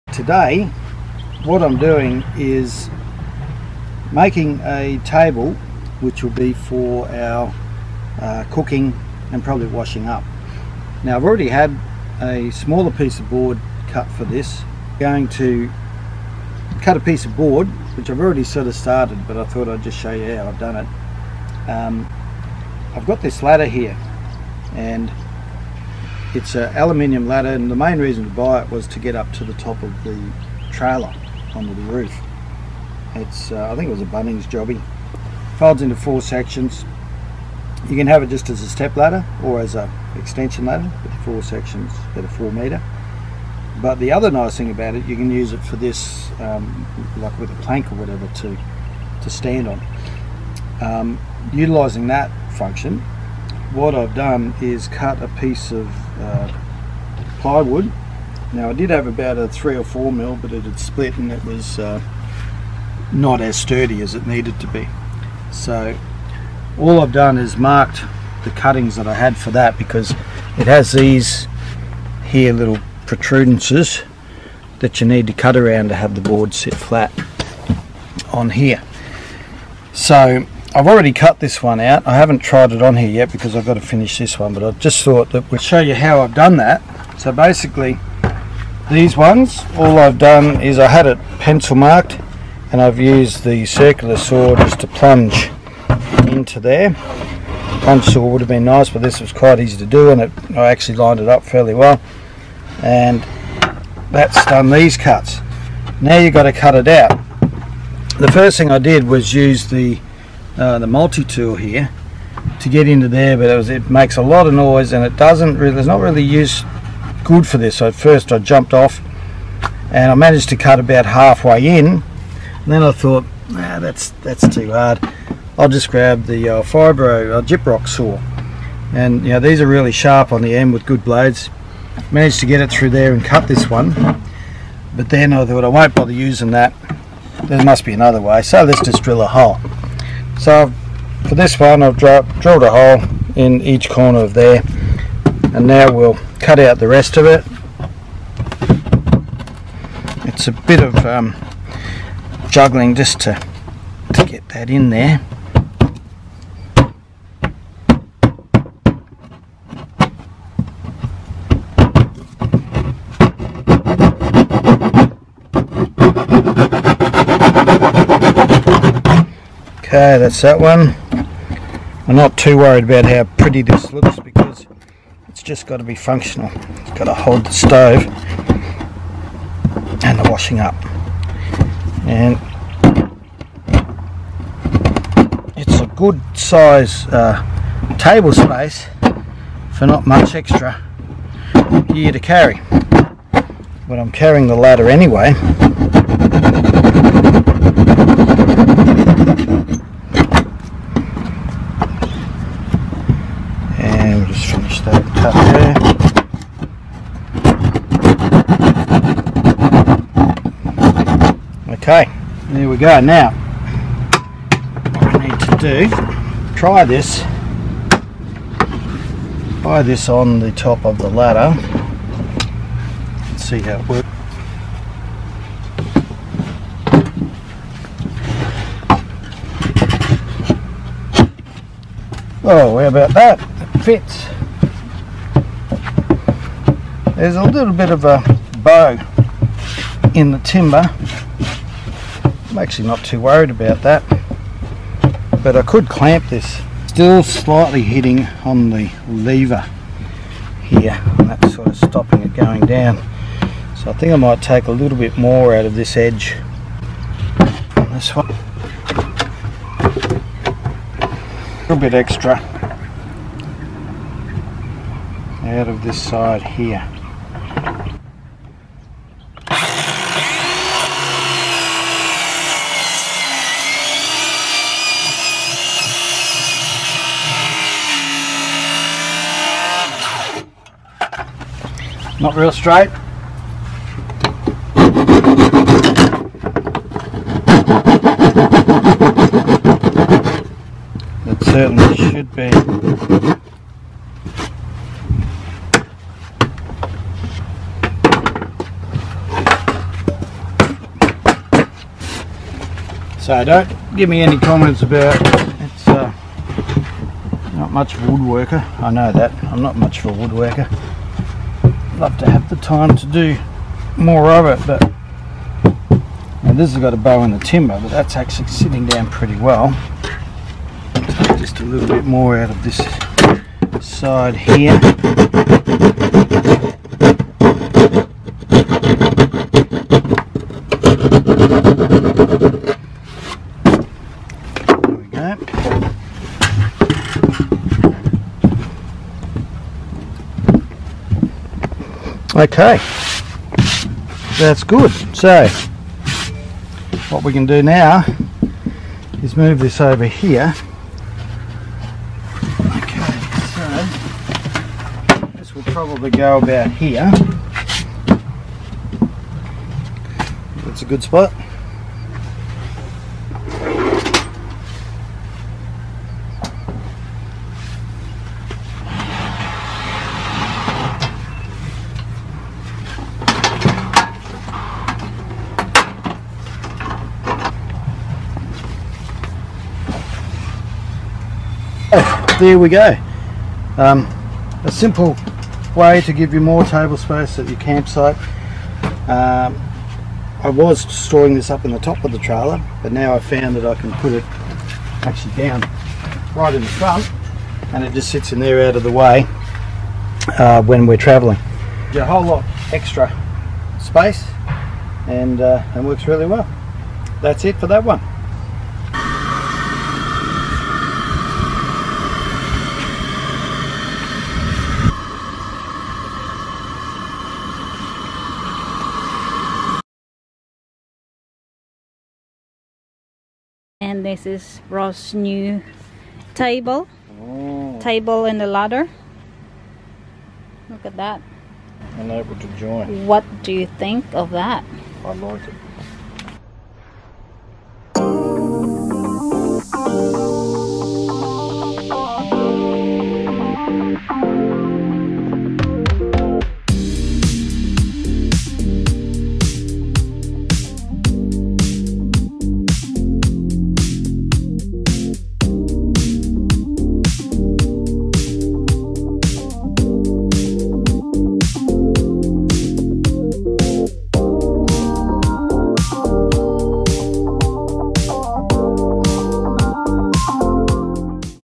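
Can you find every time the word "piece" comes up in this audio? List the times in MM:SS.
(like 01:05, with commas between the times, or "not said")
00:12, 00:16, 00:55.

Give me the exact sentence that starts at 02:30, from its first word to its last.
It's a bit of um, juggling just to, to get that in there.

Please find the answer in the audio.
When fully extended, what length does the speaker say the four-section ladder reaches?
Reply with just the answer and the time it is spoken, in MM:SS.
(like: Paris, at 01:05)
4 meters, at 00:42.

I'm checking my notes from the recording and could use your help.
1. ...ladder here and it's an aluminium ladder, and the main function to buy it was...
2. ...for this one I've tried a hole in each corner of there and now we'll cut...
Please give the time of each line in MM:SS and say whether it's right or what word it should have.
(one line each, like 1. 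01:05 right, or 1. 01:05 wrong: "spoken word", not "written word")
1. 00:23 wrong: "reason", not "function"
2. 02:21 wrong: "drilled", not "tried".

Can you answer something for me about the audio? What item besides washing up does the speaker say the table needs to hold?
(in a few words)
The stove.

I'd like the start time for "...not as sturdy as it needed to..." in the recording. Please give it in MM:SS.
01:03.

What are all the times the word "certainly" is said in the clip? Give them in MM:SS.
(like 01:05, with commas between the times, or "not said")
04:51.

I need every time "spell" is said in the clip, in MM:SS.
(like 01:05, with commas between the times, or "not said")
not said.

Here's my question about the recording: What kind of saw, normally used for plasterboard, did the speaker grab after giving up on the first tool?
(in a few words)
Gyprock saw.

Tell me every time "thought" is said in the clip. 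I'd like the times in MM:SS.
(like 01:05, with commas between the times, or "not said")
00:19, 01:25, 02:02, 02:15.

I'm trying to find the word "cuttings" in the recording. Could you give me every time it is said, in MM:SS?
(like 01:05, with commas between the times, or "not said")
01:08.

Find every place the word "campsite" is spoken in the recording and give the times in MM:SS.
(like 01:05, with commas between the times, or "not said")
06:27.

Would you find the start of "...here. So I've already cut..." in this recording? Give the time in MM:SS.
01:18.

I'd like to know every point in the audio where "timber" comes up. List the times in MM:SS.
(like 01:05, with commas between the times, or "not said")
04:00, 05:17.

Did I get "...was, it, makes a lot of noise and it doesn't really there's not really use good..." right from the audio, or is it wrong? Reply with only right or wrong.
right.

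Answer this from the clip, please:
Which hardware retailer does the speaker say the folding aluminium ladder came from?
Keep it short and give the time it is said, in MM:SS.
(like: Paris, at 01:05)
Bunnings, at 00:34.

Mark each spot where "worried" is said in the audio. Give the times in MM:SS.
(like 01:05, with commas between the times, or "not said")
02:52, 04:03.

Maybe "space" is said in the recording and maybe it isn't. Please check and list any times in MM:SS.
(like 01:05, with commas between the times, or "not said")
03:08, 06:26, 06:43.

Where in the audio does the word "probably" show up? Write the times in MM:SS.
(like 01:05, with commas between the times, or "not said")
00:09, 05:55.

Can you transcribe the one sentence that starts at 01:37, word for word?
Punch saw would have been nice, but this was quite easy to do and it, I actually lined it up fairly well.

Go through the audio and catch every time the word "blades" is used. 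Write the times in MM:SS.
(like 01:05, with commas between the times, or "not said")
02:11.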